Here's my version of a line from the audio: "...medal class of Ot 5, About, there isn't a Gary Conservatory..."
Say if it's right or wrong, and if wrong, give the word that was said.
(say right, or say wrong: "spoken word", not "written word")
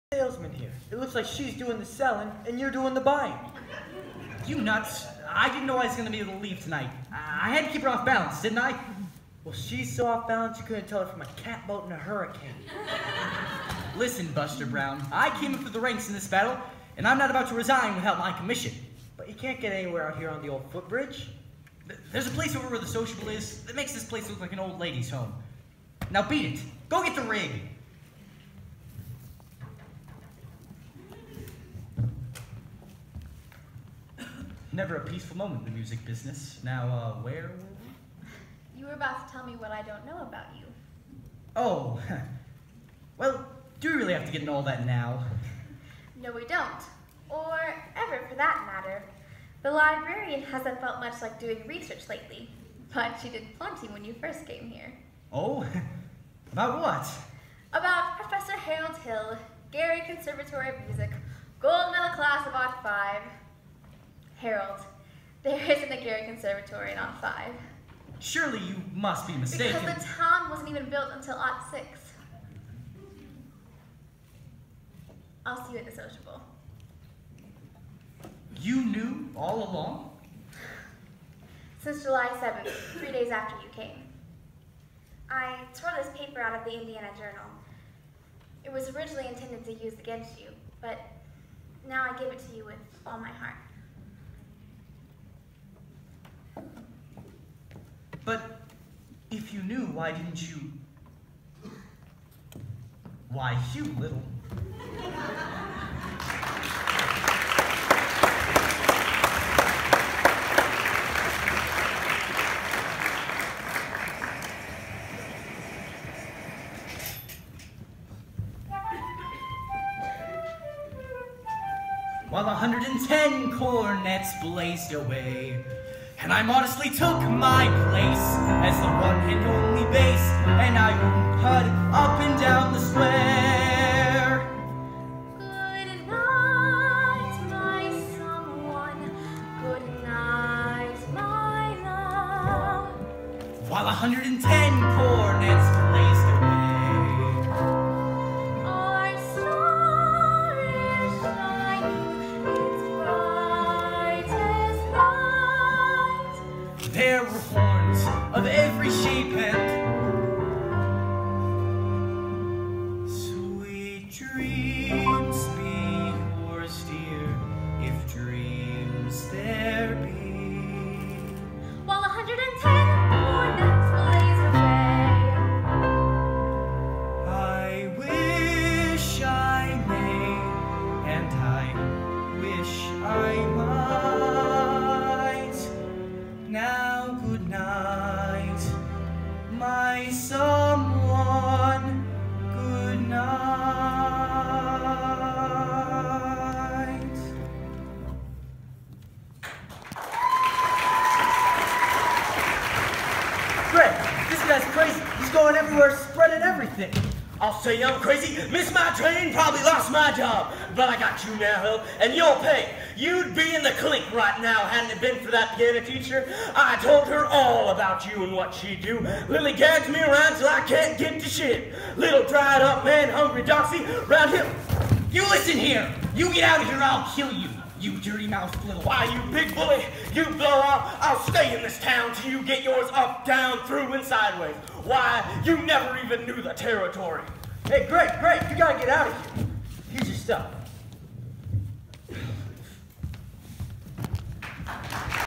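wrong: "Harold", not "About".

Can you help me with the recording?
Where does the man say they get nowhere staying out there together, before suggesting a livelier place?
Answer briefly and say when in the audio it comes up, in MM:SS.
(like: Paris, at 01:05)
the old footbridge, at 00:20.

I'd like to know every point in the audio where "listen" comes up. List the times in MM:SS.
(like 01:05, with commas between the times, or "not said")
00:13, 03:45.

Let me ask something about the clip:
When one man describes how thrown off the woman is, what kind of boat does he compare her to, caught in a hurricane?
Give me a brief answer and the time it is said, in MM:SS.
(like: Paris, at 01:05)
catboat, at 00:11.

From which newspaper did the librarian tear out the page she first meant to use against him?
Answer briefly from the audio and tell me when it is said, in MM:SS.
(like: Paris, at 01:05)
Indiana Journal, at 01:26.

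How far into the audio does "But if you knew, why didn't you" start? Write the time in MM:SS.
01:38.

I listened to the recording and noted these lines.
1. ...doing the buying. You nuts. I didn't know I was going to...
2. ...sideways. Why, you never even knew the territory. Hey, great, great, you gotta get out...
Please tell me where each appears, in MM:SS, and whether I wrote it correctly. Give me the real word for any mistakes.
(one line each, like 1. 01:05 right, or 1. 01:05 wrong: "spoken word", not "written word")
1. 00:02 right
2. 03:54 right.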